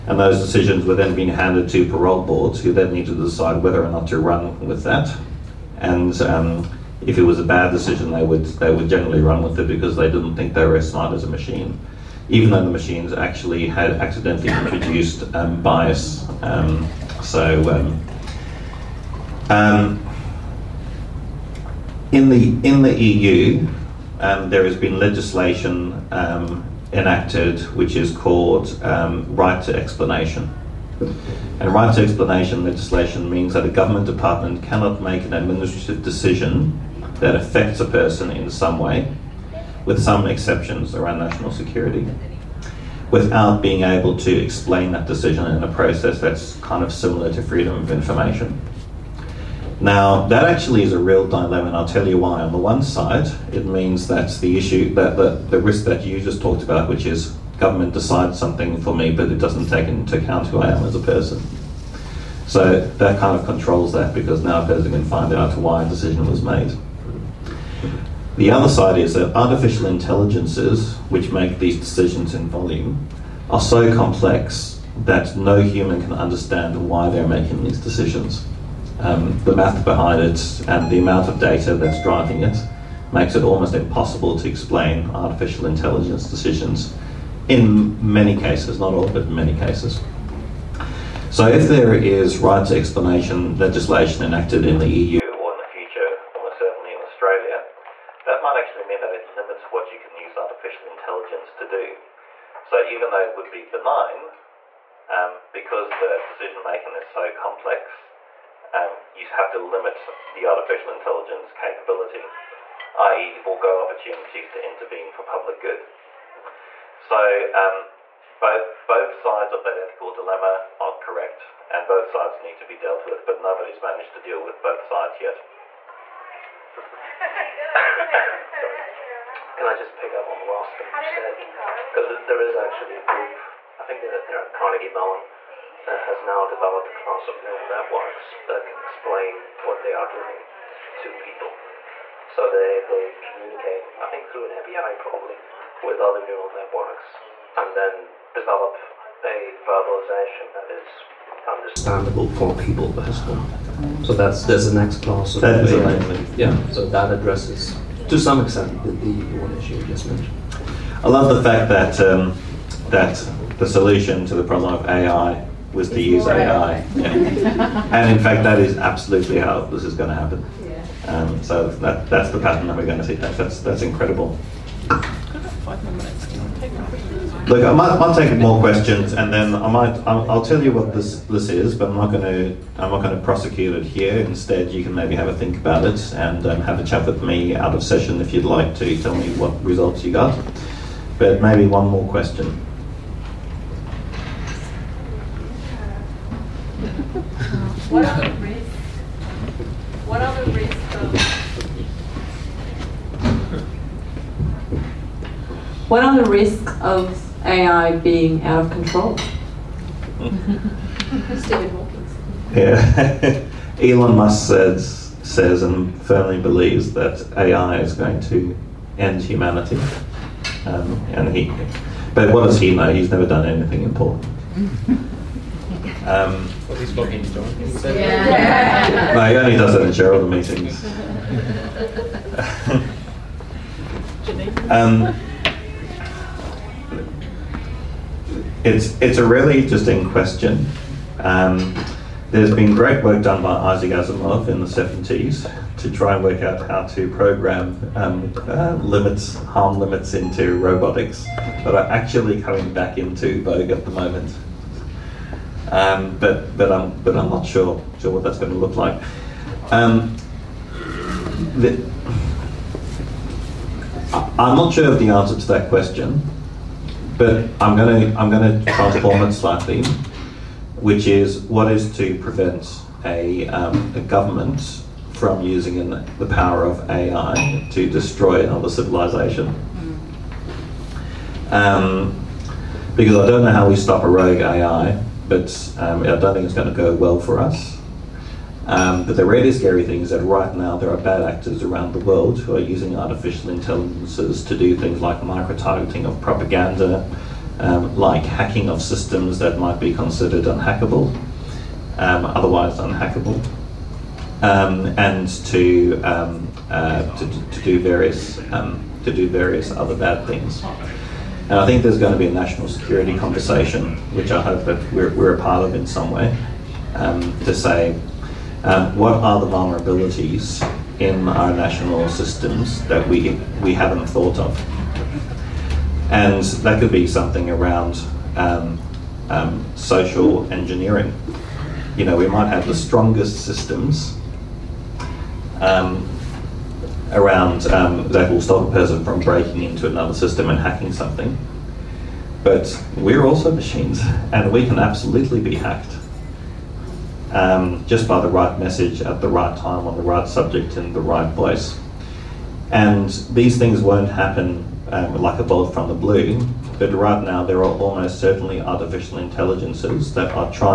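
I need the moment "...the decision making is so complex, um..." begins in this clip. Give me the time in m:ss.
1:45.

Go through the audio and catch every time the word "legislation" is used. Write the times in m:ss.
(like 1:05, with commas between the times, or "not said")
0:24, 0:32, 1:33.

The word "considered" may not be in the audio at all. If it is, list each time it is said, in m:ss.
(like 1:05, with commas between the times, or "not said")
4:59.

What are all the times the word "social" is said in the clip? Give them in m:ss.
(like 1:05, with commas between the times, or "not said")
5:29.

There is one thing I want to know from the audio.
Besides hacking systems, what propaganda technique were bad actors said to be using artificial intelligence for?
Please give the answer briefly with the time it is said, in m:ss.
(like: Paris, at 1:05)
micro-targeting, at 4:55.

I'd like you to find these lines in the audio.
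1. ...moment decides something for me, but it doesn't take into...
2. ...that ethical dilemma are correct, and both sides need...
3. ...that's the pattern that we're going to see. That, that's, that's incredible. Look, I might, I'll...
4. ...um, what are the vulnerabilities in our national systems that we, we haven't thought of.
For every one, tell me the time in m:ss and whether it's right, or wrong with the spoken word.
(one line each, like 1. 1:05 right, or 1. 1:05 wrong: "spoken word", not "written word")
1. 0:57 wrong: "government", not "moment"
2. 1:59 right
3. 2:52 right
4. 5:18 right.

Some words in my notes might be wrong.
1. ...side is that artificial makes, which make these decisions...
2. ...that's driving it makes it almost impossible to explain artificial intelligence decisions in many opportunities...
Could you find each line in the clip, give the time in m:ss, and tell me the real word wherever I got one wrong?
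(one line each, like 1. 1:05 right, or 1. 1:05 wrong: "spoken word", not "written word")
1. 1:08 wrong: "intelligences", not "makes"
2. 1:21 wrong: "cases", not "opportunities".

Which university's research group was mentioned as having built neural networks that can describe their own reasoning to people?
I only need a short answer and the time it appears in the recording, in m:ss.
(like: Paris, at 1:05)
Carnegie Mellon, at 2:14.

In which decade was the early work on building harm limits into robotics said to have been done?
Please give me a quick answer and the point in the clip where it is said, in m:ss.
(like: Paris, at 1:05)
1970s, at 4:04.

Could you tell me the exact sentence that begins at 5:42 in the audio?
But we're also machines, and we can absolutely be hacked.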